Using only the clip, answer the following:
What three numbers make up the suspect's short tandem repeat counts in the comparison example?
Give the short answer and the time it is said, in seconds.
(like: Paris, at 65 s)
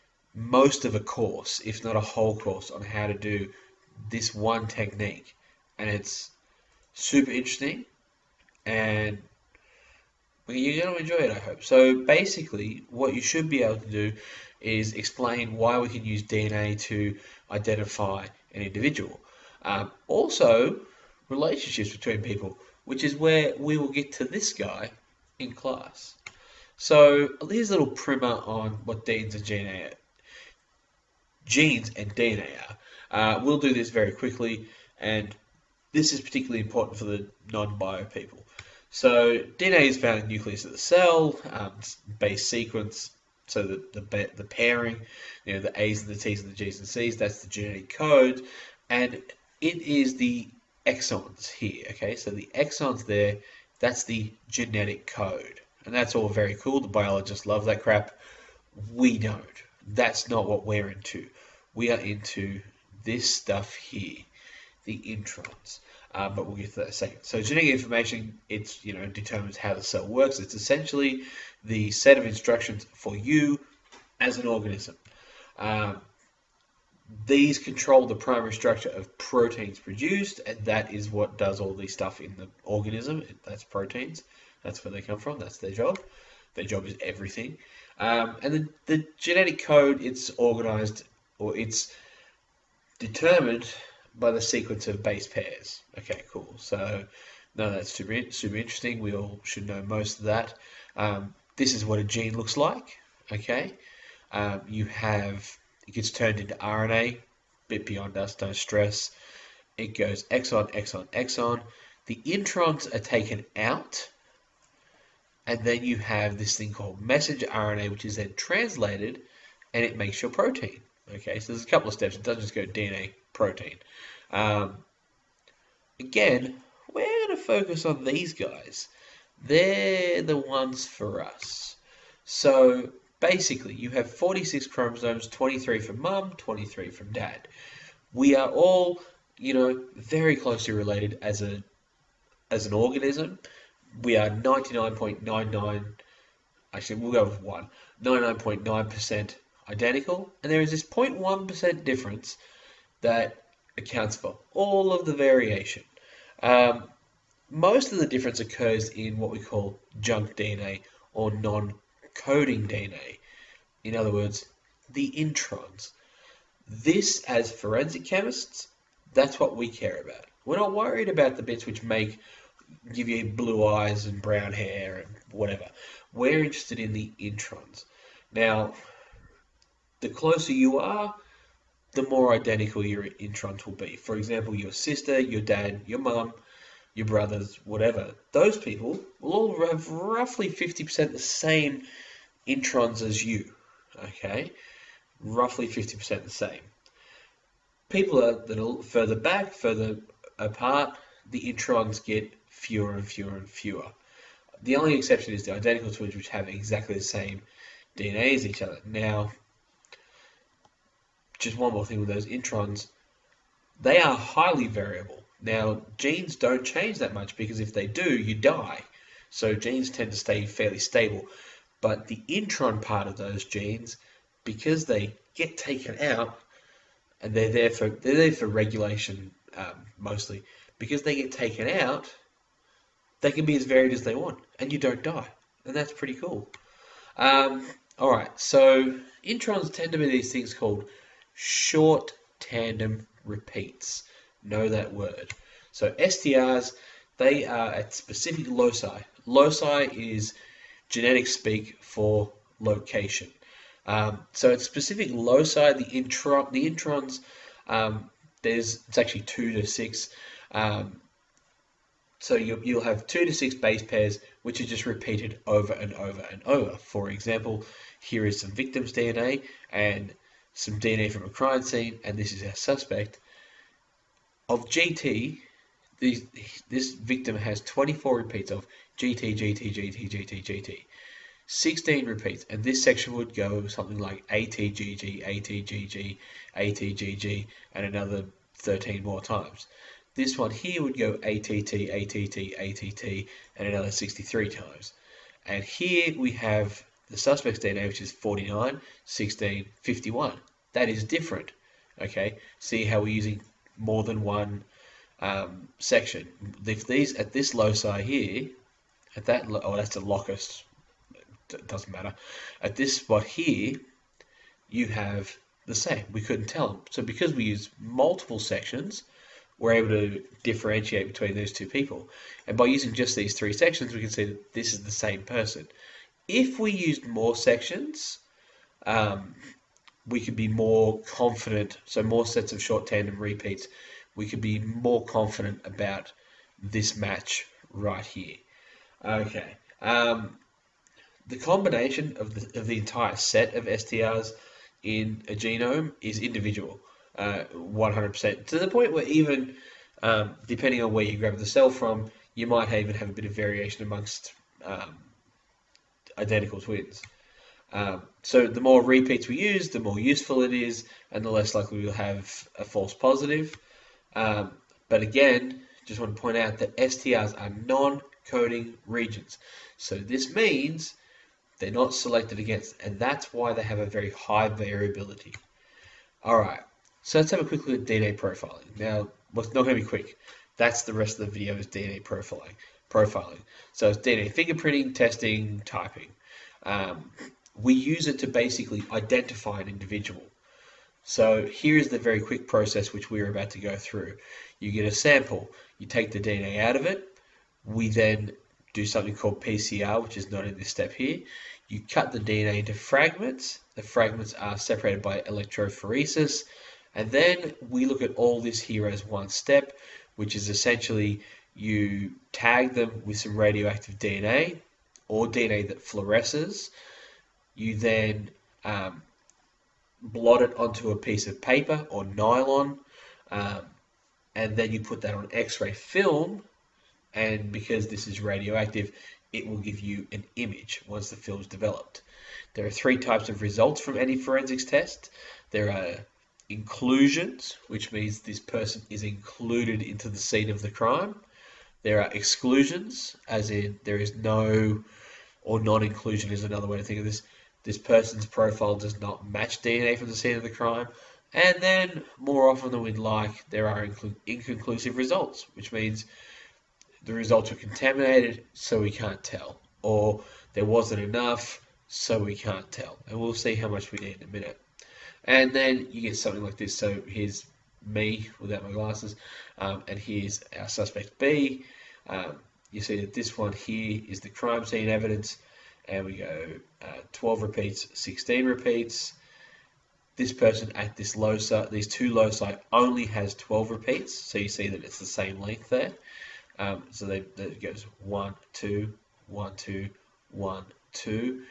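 49, 16, 51, at 298 s.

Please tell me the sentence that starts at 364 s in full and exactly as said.
Um, but again, just want to point out that STRs are non-coding regions.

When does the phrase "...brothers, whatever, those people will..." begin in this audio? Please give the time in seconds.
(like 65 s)
187 s.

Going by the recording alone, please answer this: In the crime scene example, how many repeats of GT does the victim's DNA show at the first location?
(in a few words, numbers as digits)
24.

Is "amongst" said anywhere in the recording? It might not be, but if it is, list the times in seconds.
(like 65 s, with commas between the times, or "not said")
353 s.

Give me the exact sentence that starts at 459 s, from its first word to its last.
Or there wasn't enough, so we can't tell.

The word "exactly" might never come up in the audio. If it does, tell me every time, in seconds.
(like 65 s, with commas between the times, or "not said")
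206 s.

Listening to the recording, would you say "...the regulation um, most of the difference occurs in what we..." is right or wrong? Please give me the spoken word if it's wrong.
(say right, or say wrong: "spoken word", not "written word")
wrong: "variation", not "regulation".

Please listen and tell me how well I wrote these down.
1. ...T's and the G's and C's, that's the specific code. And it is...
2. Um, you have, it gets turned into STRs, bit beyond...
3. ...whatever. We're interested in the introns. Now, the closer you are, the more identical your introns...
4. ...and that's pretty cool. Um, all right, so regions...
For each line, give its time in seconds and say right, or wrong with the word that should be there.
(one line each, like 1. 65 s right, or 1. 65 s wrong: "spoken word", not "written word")
1. 46 s wrong: "genetic", not "specific"
2. 104 s wrong: "RNA", not "STRs"
3. 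175 s right
4. 235 s wrong: "introns", not "regions".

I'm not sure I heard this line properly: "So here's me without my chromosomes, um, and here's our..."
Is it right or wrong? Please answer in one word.
wrong.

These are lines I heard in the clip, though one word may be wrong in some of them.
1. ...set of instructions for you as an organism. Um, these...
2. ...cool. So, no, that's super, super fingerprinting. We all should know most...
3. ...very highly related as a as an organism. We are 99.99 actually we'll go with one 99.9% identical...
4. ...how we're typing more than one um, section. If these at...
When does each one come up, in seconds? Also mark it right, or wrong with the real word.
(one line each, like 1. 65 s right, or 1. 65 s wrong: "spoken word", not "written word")
1. 71 s right
2. 96 s wrong: "interesting", not "fingerprinting"
3. 139 s wrong: "closely", not "highly"
4. 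302 s wrong: "using", not "typing".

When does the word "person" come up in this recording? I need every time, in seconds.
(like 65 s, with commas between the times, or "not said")
325 s, 438 s, 447 s, 480 s.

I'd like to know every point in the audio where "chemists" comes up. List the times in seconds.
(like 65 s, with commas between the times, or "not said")
168 s.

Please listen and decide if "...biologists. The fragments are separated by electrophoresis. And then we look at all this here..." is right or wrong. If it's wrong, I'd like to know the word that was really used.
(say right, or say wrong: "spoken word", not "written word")
wrong: "fragments", not "biologists".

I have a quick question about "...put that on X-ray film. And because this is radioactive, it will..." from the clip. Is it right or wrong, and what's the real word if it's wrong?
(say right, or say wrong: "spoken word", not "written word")
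right.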